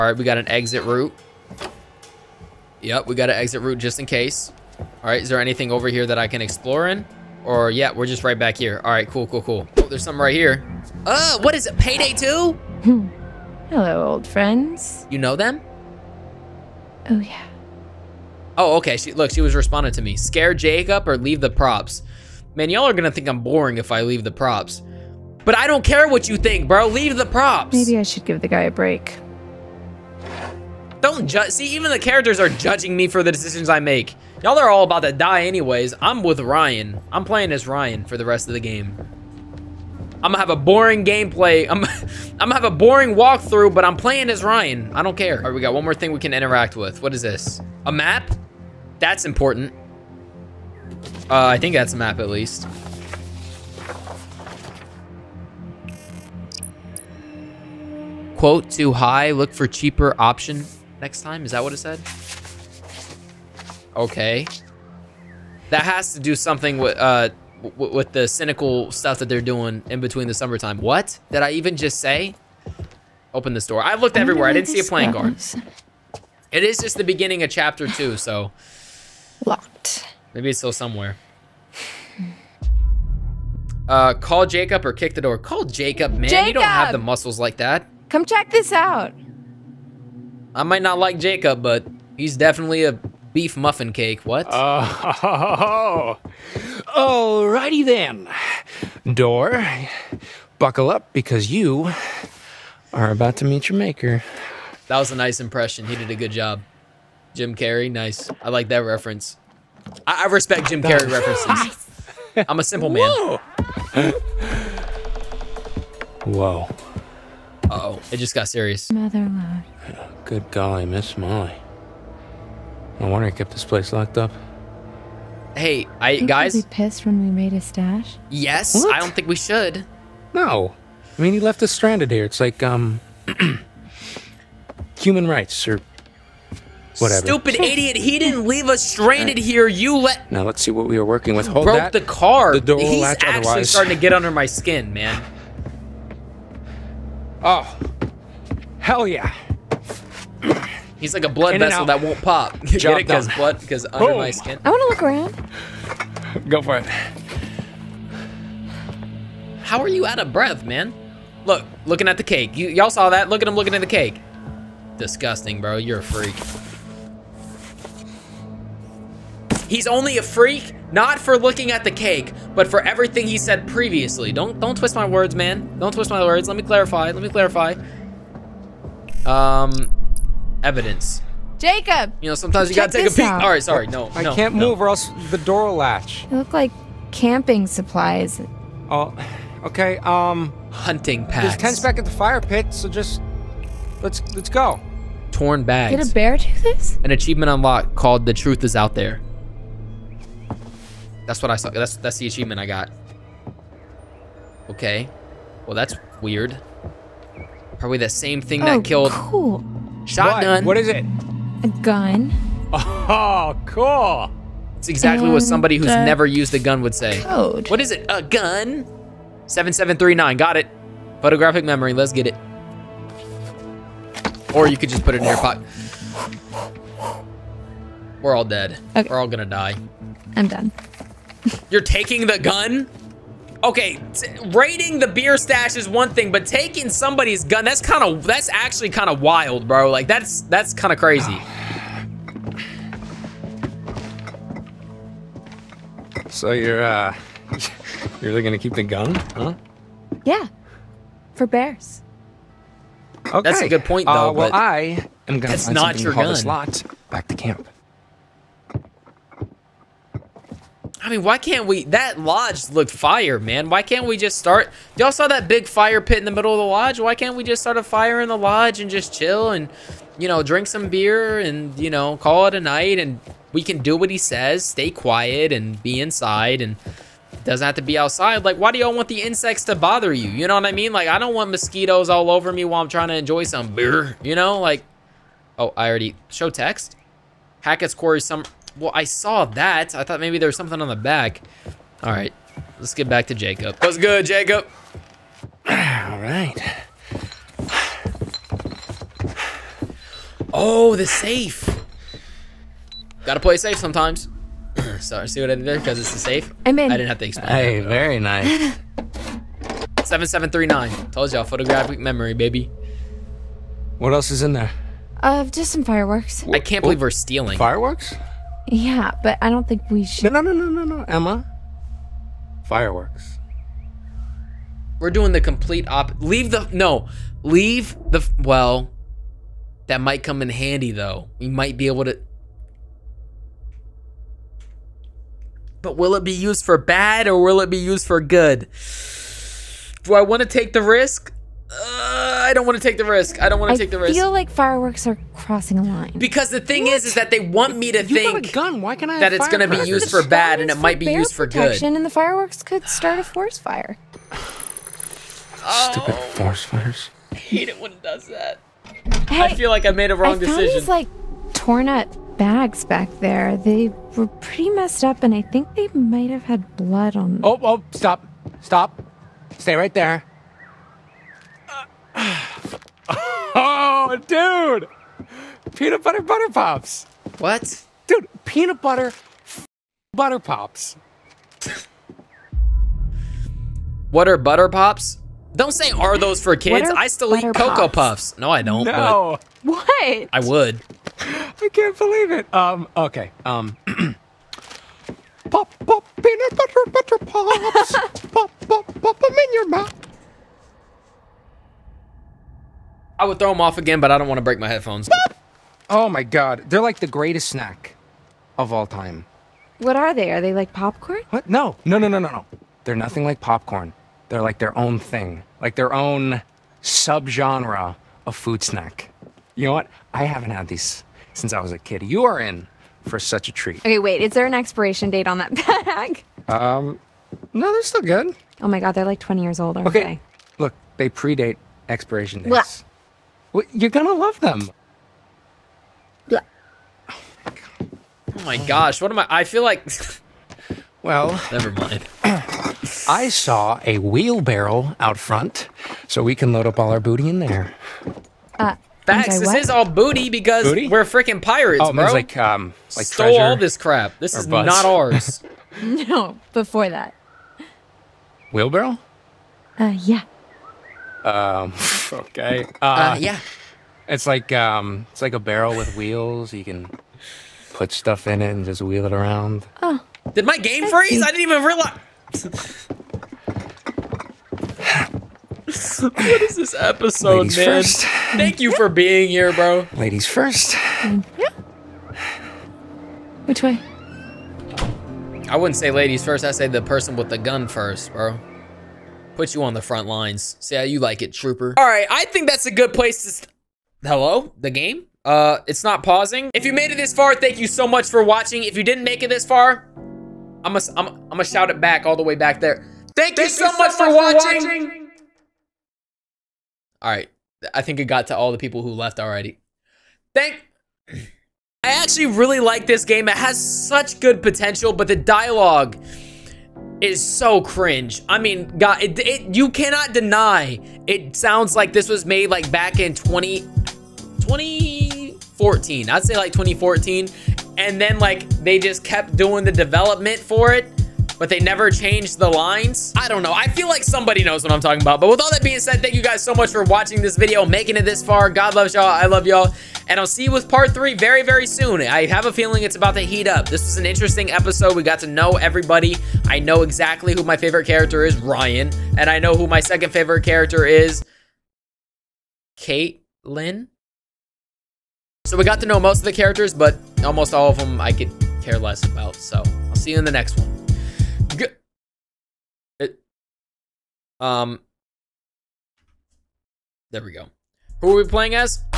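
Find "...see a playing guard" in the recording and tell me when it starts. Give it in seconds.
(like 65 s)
74 s.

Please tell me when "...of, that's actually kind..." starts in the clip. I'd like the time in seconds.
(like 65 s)
238 s.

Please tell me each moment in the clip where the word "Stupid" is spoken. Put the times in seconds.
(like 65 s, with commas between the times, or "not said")
137 s, 355 s.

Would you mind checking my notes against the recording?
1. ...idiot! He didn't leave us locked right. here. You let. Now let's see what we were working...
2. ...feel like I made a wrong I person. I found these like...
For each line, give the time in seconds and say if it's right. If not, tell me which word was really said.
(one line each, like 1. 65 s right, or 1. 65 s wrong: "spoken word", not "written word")
1. 137 s wrong: "stranded", not "locked"
2. 359 s wrong: "decision", not "person".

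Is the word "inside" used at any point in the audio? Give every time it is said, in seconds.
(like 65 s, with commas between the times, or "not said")
275 s.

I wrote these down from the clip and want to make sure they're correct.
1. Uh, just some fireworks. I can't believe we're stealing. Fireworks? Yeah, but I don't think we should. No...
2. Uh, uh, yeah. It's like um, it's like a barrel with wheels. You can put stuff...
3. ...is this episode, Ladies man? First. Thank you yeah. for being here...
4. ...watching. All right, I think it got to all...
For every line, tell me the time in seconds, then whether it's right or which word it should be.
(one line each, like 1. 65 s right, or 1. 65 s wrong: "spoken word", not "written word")
1. 315 s right
2. 462 s right
3. 476 s right
4. 504 s right.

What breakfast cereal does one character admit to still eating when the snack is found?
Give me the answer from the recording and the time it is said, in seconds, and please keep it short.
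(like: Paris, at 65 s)
Cocoa Puffs, at 387 s.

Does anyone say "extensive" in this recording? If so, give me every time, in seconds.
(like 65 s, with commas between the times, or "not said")
not said.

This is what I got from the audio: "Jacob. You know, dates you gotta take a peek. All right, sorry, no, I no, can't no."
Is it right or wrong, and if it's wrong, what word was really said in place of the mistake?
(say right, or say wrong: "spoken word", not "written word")
wrong: "sometimes", not "dates".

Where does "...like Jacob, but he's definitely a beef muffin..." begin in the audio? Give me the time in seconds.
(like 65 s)
90 s.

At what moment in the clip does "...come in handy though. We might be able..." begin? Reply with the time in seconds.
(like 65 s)
330 s.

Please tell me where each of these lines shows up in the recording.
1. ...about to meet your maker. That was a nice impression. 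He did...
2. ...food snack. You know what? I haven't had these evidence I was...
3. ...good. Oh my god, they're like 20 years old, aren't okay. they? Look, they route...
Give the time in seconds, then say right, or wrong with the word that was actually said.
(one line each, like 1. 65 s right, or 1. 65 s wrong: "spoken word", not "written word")
1. 103 s right
2. 418 s wrong: "since", not "evidence"
3. 428 s wrong: "predate", not "route".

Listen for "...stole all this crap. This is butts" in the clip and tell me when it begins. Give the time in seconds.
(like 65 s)
453 s.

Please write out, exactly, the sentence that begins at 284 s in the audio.
Like, oh, I already show text.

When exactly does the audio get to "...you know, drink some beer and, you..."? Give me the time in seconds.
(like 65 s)
270 s.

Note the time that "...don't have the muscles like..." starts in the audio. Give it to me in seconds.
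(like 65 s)
86 s.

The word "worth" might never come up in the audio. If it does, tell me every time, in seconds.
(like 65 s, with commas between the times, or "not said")
not said.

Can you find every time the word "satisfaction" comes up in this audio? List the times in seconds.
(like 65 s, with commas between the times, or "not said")
not said.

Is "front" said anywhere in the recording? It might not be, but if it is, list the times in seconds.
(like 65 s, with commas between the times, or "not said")
445 s, 489 s.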